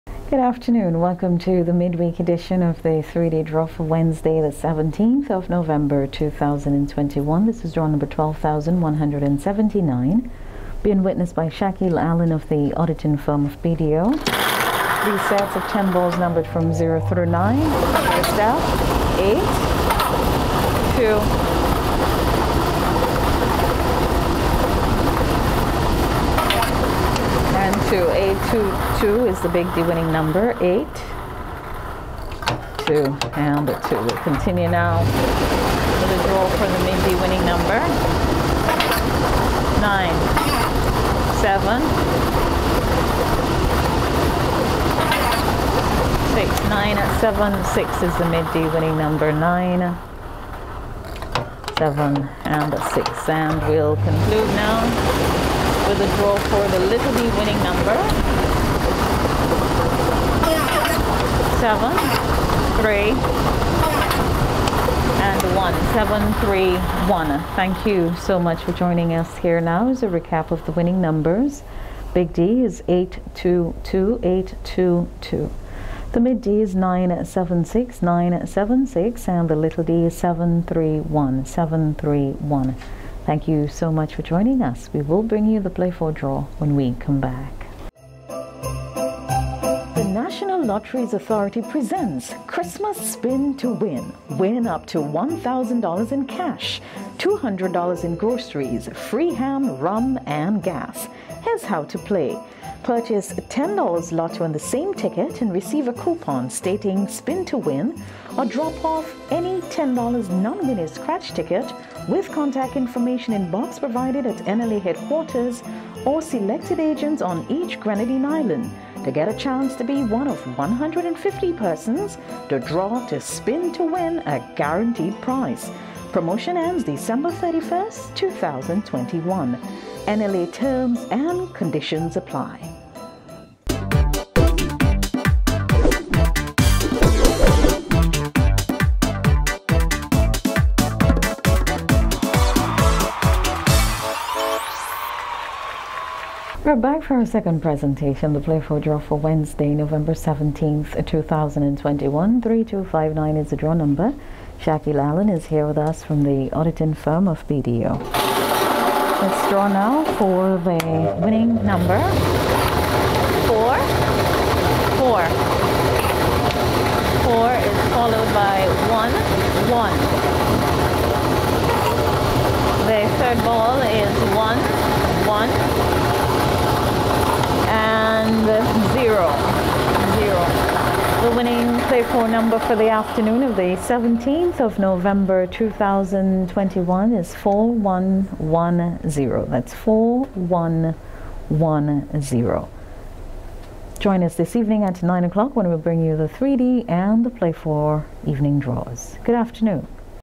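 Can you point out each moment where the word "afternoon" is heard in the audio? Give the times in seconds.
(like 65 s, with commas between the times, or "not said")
0 s, 182 s, 199 s.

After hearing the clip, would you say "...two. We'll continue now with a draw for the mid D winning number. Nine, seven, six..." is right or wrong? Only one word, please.
right.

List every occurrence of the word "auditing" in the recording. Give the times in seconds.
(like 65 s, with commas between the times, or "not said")
12 s, 156 s.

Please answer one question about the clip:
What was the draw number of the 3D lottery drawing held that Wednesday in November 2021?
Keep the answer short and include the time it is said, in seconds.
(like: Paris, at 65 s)
12,179, at 8 s.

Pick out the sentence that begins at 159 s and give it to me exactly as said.
Let's draw now for the winning number.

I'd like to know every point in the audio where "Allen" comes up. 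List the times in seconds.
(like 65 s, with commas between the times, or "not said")
12 s, 154 s.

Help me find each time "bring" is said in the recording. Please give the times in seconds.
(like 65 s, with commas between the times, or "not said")
85 s, 195 s.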